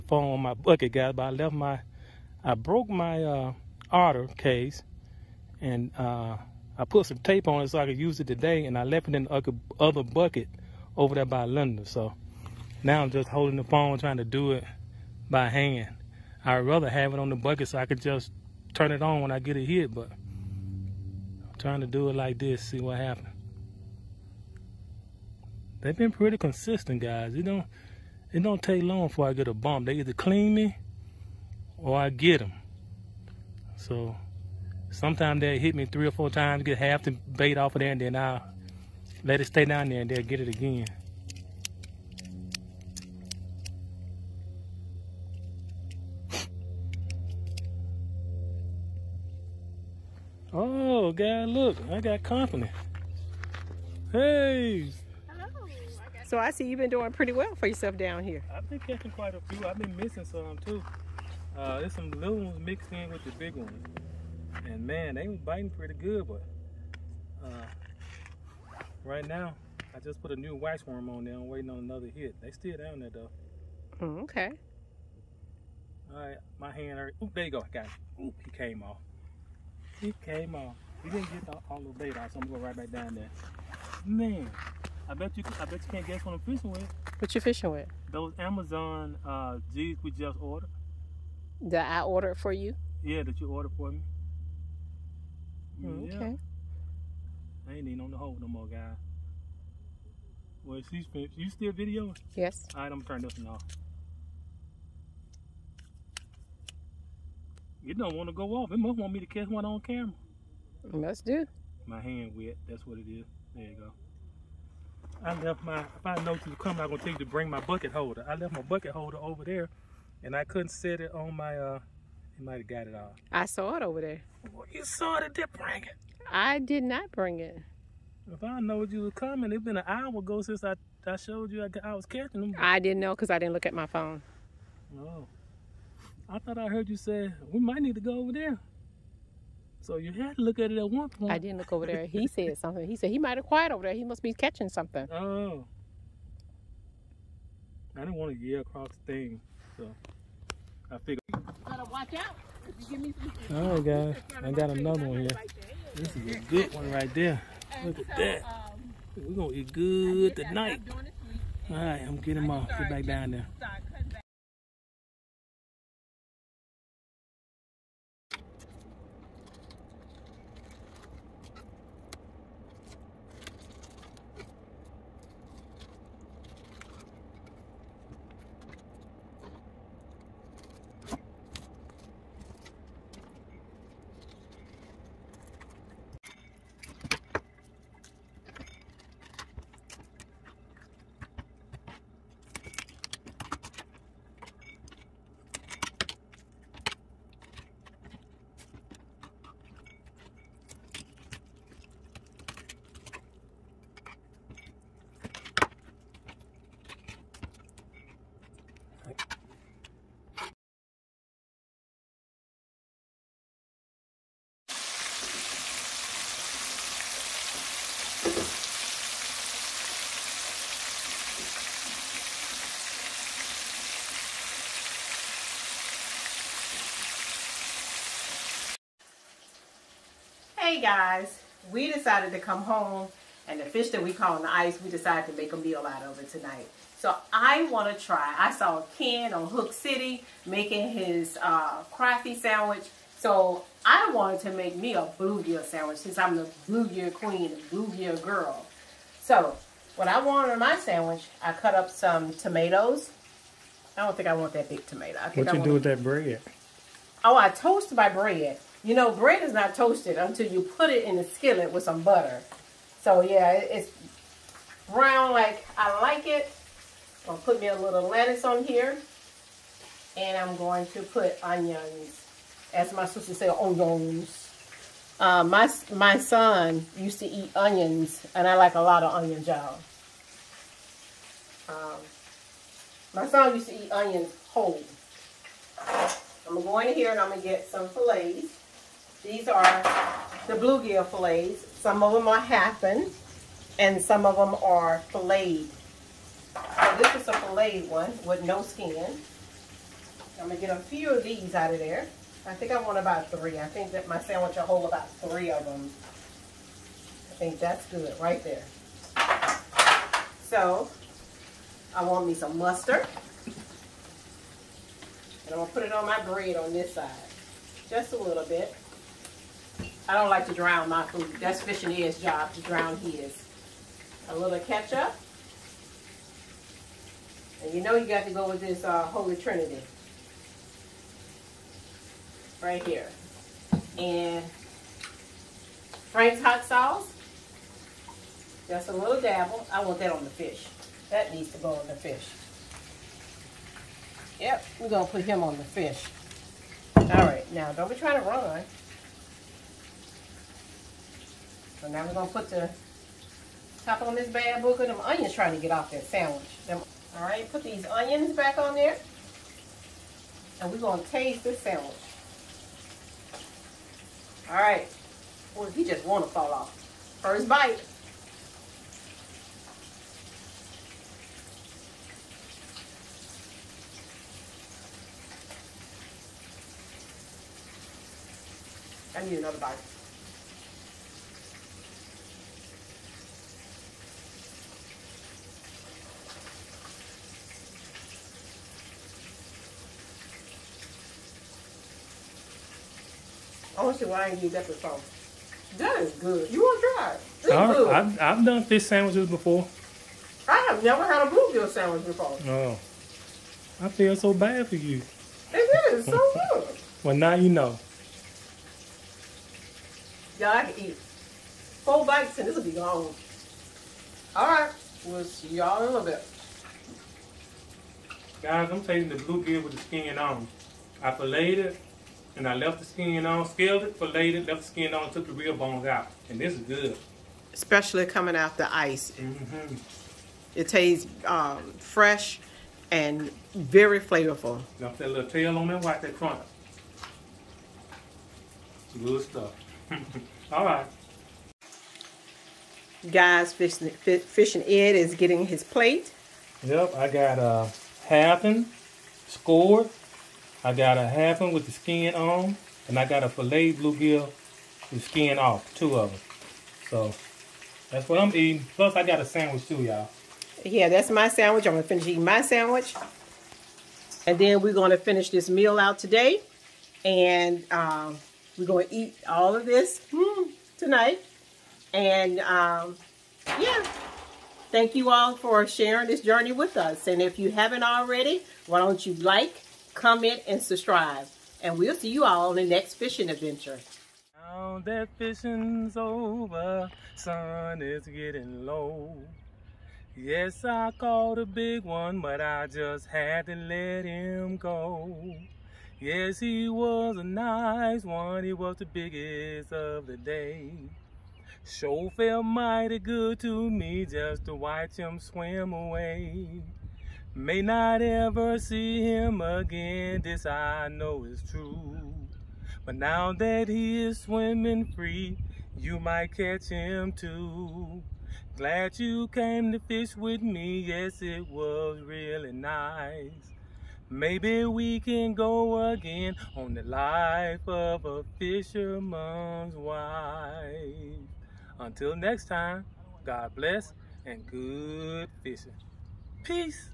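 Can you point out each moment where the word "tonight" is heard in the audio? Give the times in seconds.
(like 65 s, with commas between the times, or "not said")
160 s, 236 s, 470 s.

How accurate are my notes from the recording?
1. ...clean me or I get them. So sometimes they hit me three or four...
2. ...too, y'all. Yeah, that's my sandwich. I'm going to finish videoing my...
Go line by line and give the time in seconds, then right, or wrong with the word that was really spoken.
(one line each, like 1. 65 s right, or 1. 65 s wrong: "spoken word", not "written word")
1. 30 s right
2. 459 s wrong: "eating", not "videoing".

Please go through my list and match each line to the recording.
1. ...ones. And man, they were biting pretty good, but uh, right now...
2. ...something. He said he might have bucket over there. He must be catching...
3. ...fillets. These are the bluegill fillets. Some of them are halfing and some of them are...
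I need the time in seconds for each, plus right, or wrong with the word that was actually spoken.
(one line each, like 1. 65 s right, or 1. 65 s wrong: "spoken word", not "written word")
1. 63 s right
2. 142 s wrong: "quiet", not "bucket"
3. 287 s right.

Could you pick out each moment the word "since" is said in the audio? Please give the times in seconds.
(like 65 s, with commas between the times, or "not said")
130 s, 245 s.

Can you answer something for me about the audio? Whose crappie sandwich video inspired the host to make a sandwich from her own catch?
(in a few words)
Ken.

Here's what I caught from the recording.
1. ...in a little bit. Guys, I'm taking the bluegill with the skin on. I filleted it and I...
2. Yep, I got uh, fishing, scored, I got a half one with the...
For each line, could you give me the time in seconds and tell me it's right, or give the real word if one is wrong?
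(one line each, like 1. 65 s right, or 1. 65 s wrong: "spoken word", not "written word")
1. 415 s right
2. 446 s wrong: "halving", not "fishing".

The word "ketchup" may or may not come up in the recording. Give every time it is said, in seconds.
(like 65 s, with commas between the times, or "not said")
324 s.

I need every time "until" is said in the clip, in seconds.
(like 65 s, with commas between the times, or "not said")
260 s, 531 s.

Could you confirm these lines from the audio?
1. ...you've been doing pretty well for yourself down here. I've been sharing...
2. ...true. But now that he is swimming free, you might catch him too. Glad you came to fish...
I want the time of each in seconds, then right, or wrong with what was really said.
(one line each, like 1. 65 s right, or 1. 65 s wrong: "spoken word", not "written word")
1. 56 s wrong: "catching", not "sharing"
2. 511 s right.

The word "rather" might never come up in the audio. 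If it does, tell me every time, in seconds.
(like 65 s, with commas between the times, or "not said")
16 s.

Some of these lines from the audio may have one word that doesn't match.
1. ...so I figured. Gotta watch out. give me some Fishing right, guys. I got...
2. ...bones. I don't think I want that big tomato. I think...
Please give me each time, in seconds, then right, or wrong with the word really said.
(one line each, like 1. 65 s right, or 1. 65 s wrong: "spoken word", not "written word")
1. 149 s wrong: "All", not "Fishing"
2. 252 s wrong: "tomatoes", not "bones".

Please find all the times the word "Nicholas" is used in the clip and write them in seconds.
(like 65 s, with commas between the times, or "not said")
not said.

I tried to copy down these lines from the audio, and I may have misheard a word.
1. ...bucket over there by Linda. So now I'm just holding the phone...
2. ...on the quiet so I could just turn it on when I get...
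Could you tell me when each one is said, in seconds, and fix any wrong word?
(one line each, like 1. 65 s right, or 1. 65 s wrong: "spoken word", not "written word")
1. 10 s right
2. 17 s wrong: "bucket", not "quiet".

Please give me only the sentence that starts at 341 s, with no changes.
That needs to go on the fish.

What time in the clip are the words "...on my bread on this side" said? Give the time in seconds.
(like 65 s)
315 s.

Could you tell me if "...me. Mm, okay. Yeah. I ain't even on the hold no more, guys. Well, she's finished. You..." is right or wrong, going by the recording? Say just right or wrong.
right.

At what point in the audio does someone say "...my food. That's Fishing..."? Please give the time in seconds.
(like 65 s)
320 s.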